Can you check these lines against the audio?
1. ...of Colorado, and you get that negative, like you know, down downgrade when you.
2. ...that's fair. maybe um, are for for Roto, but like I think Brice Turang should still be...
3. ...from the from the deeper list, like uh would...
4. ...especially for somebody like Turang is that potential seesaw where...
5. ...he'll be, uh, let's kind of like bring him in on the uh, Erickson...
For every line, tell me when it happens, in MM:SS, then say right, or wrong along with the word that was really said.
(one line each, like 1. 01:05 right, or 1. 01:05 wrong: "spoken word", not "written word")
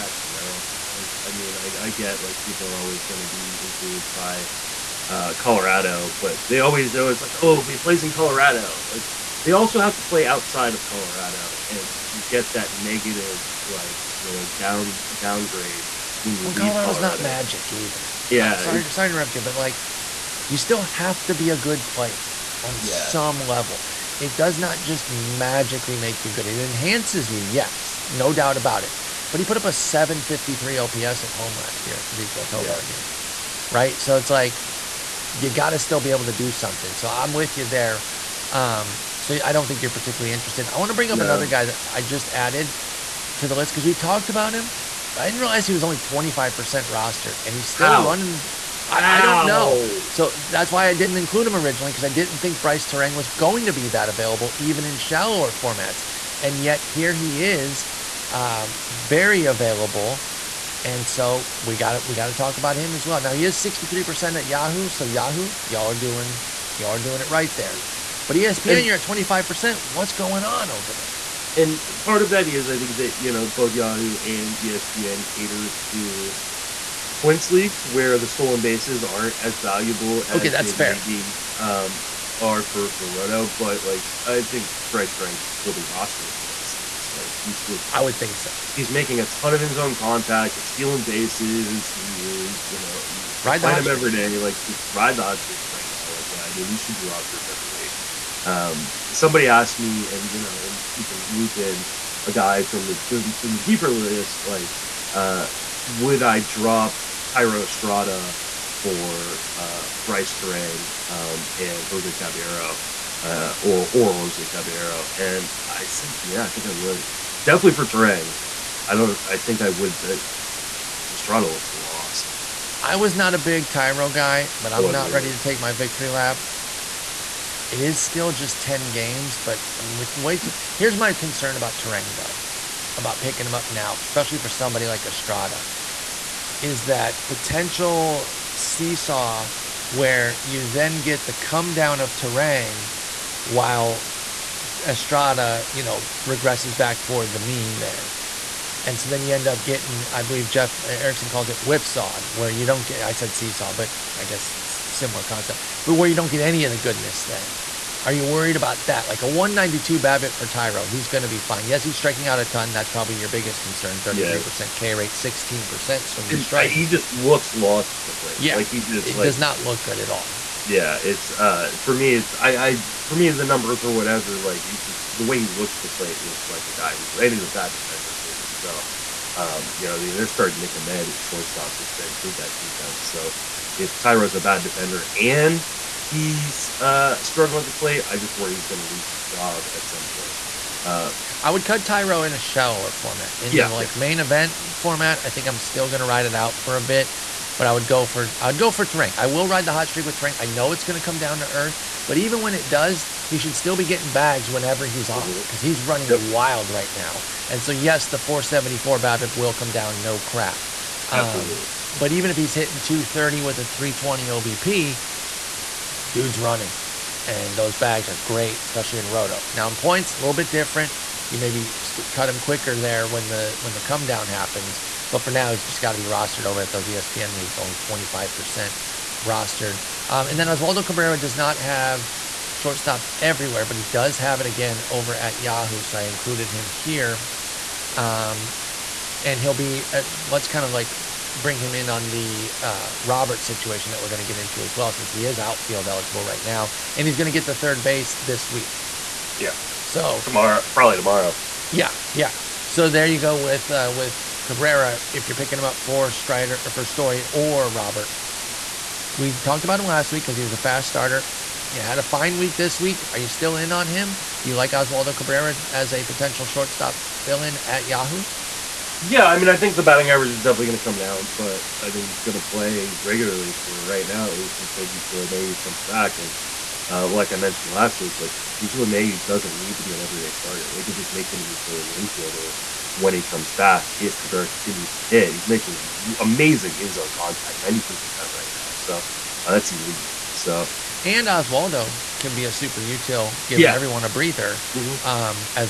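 1. 00:10 right
2. 01:20 right
3. 01:42 right
4. 02:13 wrong: "Estrada", not "Turang"
5. 03:59 wrong: "Robert", not "Erickson".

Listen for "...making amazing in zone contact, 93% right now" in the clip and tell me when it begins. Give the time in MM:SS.
04:45.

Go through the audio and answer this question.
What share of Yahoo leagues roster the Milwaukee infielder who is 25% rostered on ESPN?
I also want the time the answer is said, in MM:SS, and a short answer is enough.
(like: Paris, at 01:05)
63%, at 01:03.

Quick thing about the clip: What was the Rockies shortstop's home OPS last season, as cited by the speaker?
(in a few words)
753.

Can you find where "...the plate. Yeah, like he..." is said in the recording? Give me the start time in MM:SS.
02:48.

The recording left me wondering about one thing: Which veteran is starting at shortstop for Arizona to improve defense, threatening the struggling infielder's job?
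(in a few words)
Nick Ahmed.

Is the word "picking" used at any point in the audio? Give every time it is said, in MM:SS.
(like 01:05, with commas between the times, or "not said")
02:13, 04:15.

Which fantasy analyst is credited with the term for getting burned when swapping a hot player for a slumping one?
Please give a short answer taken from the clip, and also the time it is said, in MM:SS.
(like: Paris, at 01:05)
Jeff Erickson, at 02:30.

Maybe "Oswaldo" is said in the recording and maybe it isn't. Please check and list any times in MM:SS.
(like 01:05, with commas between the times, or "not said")
03:50, 04:24, 04:51.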